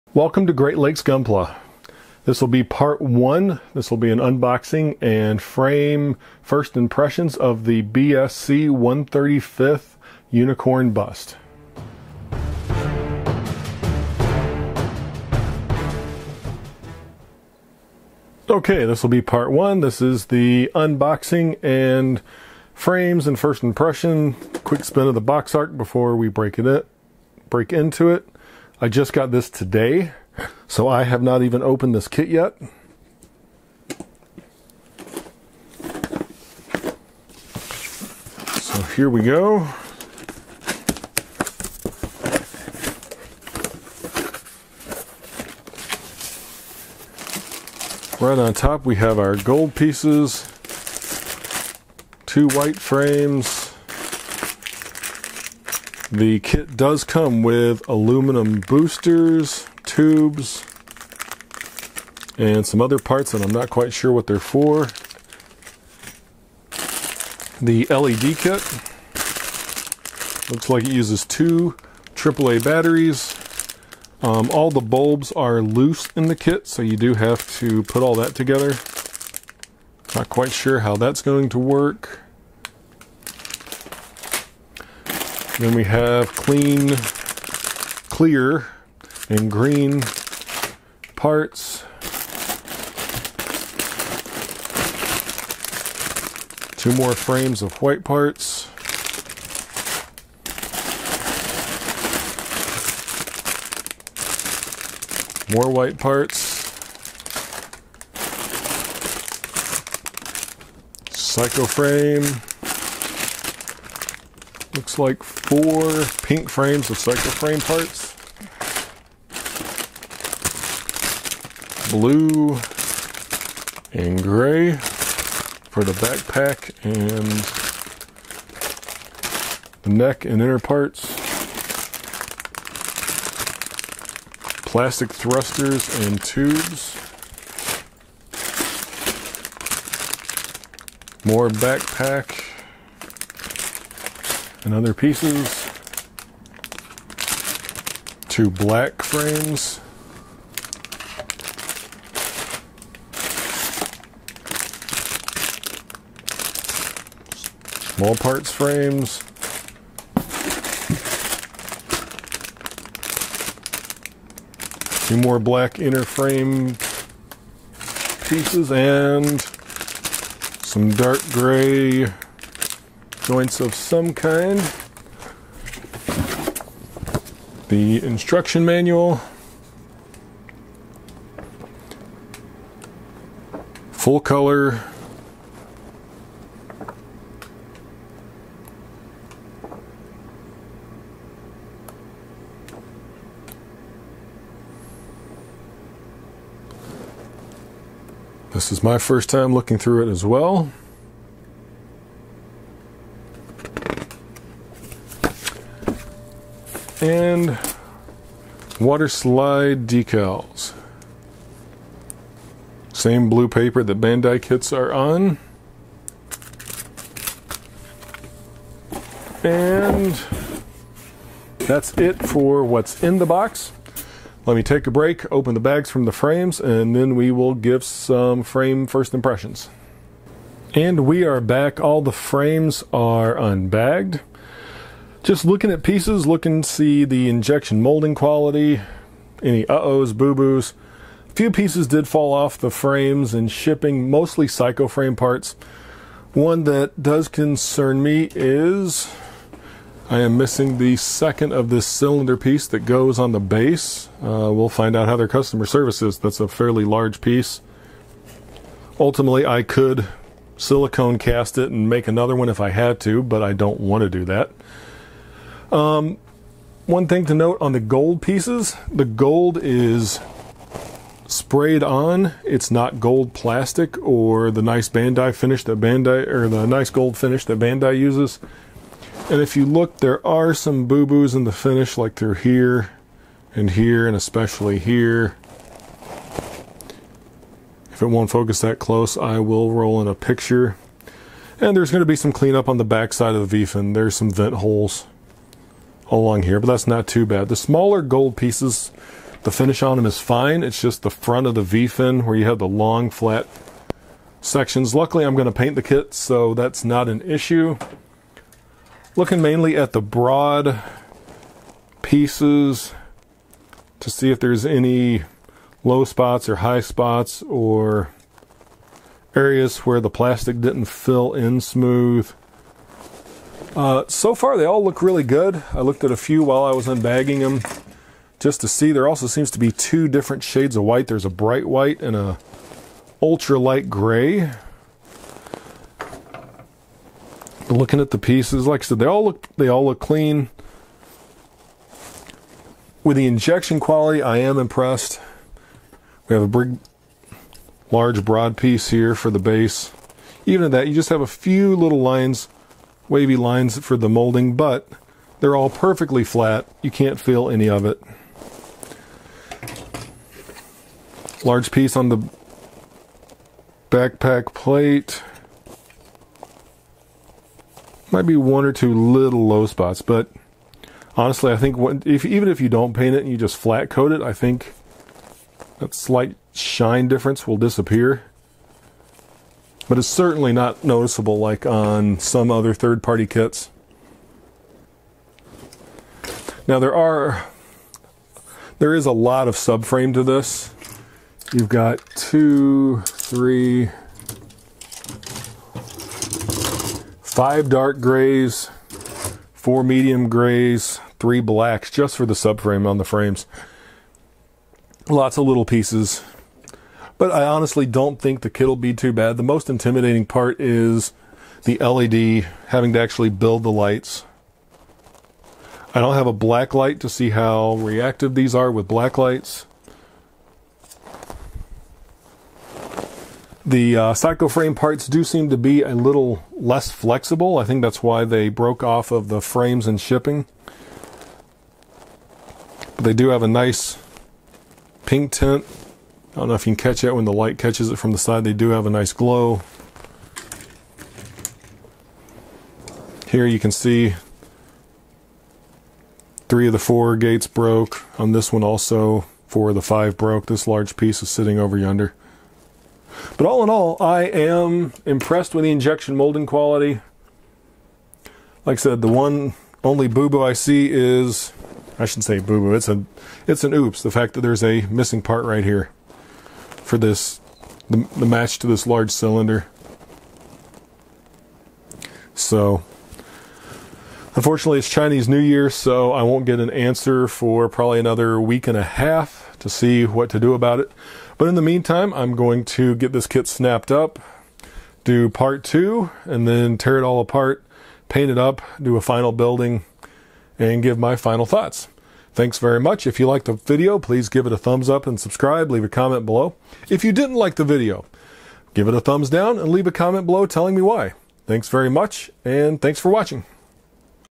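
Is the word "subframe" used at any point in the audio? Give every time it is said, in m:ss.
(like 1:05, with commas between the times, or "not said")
6:29, 6:42.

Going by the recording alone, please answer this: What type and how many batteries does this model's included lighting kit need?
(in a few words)
2 AAA batteries.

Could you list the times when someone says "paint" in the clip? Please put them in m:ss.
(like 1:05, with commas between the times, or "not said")
5:05, 6:12, 8:08.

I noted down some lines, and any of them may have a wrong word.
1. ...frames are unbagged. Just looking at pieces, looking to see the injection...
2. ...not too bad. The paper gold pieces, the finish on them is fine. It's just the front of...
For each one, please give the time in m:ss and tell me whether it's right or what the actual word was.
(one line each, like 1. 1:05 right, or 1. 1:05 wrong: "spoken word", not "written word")
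1. 3:52 right
2. 4:56 wrong: "smaller", not "paper".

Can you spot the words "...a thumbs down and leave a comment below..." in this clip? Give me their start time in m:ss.
8:18.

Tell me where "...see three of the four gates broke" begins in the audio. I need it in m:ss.
7:23.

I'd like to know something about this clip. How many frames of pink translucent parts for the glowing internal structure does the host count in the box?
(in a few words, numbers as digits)
4.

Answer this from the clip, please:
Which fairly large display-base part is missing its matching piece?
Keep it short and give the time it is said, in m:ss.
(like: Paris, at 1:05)
Cylinder piece, at 4:11.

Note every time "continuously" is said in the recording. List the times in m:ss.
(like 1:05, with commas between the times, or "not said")
not said.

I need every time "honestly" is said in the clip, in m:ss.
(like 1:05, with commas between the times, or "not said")
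6:11, 6:47.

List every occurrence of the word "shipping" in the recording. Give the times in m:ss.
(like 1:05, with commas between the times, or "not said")
4:03, 7:10.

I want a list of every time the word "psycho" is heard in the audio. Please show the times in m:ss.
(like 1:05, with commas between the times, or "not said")
1:51, 1:56, 4:04, 7:04.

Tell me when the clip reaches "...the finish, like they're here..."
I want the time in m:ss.
4:41.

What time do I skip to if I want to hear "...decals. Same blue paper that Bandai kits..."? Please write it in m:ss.
3:29.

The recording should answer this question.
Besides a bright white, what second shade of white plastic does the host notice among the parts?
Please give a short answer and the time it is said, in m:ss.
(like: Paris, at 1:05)
Ultra light gray, at 5:33.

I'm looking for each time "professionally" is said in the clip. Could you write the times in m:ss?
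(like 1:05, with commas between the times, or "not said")
not said.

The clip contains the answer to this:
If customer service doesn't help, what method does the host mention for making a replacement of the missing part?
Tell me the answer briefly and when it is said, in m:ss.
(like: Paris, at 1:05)
Silicone cast, at 4:20.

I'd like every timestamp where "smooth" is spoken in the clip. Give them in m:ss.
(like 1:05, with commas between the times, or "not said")
5:21.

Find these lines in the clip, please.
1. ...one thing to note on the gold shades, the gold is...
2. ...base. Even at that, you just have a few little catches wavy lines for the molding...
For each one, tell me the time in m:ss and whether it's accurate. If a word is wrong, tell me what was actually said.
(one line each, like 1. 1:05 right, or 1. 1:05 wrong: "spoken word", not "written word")
1. 4:26 wrong: "pieces", not "shades"
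2. 5:49 wrong: "lines", not "catches".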